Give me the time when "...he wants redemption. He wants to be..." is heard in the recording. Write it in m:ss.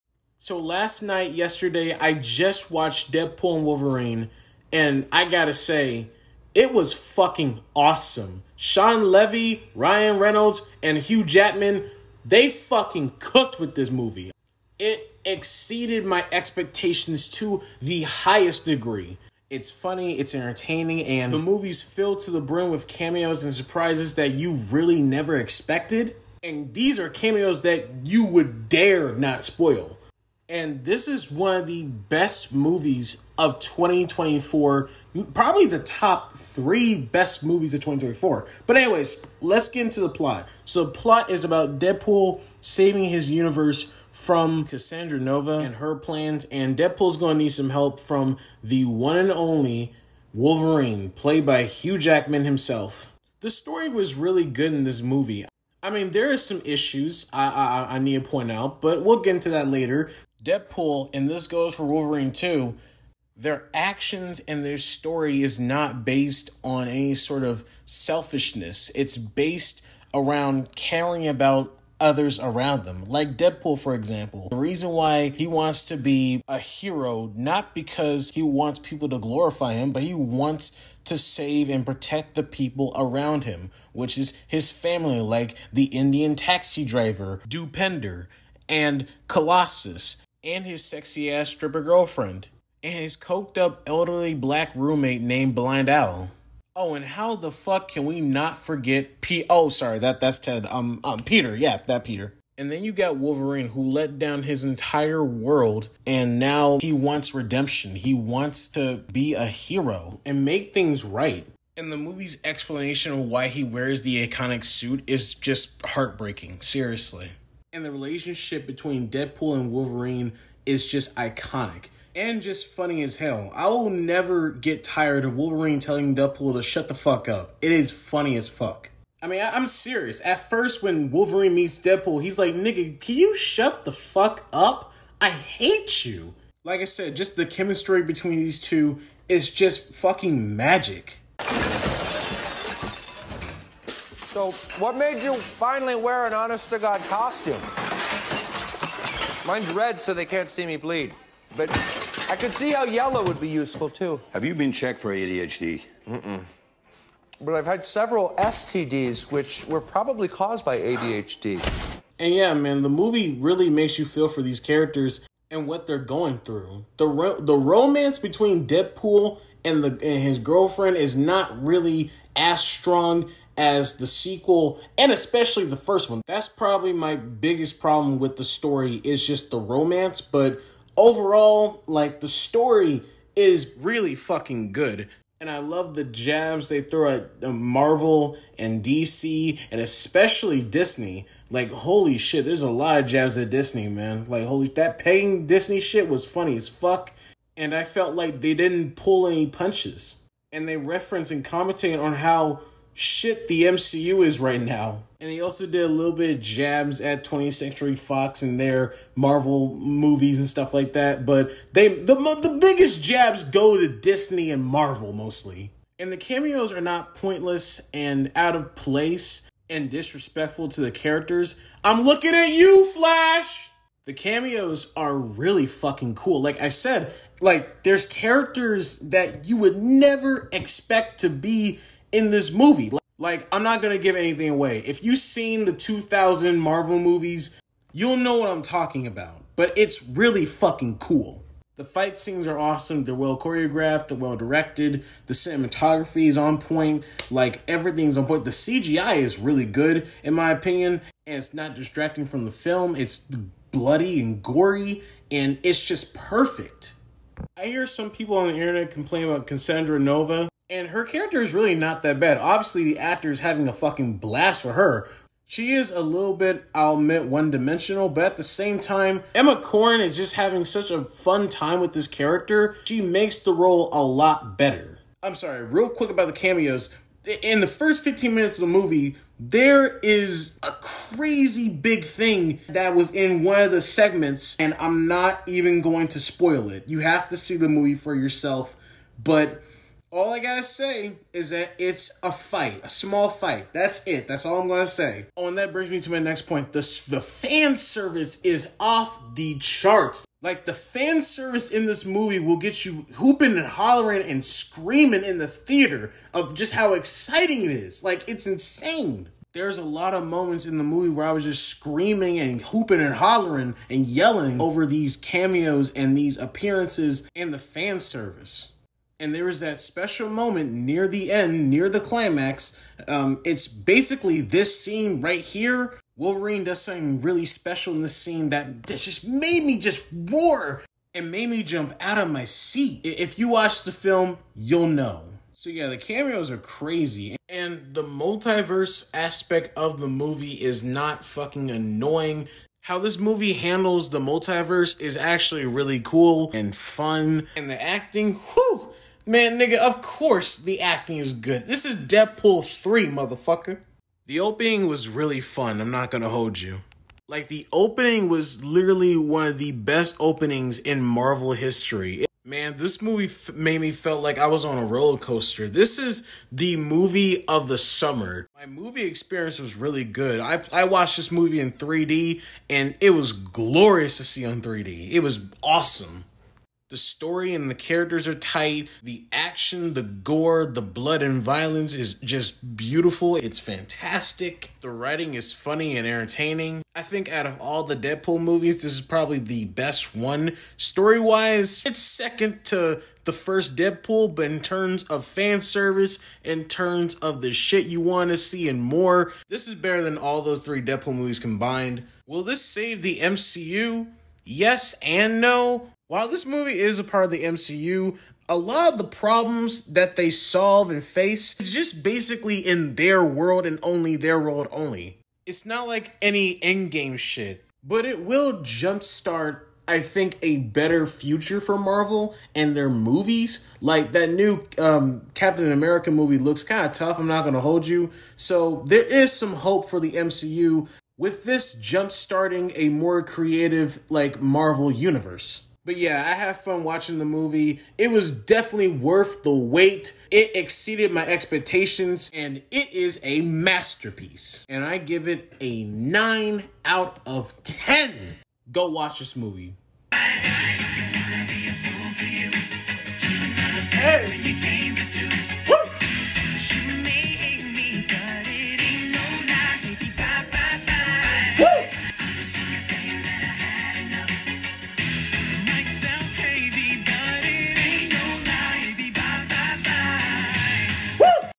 1:46.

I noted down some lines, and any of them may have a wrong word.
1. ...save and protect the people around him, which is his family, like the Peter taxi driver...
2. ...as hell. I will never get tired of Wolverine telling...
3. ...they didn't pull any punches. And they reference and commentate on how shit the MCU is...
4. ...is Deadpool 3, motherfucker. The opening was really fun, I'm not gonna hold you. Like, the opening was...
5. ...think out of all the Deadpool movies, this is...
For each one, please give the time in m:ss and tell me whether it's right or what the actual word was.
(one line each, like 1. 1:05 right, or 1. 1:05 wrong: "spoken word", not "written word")
1. 1:21 wrong: "Indian", not "Peter"
2. 2:03 right
3. 3:18 right
4. 5:51 right
5. 6:27 right.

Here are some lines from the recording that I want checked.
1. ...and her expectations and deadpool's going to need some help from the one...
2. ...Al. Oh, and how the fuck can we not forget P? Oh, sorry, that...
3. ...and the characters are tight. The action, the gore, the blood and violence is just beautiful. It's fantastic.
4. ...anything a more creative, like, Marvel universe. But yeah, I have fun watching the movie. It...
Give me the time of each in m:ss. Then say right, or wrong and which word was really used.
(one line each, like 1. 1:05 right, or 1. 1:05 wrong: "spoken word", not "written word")
1. 0:45 wrong: "plans", not "expectations"
2. 1:35 right
3. 6:17 right
4. 7:11 wrong: "jumpstarting", not "anything".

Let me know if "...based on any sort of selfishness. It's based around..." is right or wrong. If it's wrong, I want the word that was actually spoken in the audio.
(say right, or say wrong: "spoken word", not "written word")
right.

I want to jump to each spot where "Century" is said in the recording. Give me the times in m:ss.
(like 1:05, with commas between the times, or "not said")
3:27.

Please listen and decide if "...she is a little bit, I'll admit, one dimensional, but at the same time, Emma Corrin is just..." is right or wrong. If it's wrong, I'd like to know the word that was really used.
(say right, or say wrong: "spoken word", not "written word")
right.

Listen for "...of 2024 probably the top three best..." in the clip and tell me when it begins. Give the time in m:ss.
0:33.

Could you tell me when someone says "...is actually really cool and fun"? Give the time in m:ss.
5:44.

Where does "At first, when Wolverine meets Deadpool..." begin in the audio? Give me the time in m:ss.
2:10.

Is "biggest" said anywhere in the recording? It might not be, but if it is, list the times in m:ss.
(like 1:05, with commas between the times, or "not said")
2:57, 3:32.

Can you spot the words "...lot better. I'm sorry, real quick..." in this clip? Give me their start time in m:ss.
4:34.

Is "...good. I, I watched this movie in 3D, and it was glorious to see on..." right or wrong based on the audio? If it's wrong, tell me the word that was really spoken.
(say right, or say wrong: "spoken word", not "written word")
right.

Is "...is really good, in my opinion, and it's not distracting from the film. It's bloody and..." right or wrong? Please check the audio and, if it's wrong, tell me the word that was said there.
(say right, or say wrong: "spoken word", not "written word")
right.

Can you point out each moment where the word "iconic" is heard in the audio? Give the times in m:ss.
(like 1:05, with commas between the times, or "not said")
1:54, 2:01.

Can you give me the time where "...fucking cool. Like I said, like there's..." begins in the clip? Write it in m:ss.
3:45.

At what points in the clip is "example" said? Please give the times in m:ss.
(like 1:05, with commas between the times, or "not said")
1:13.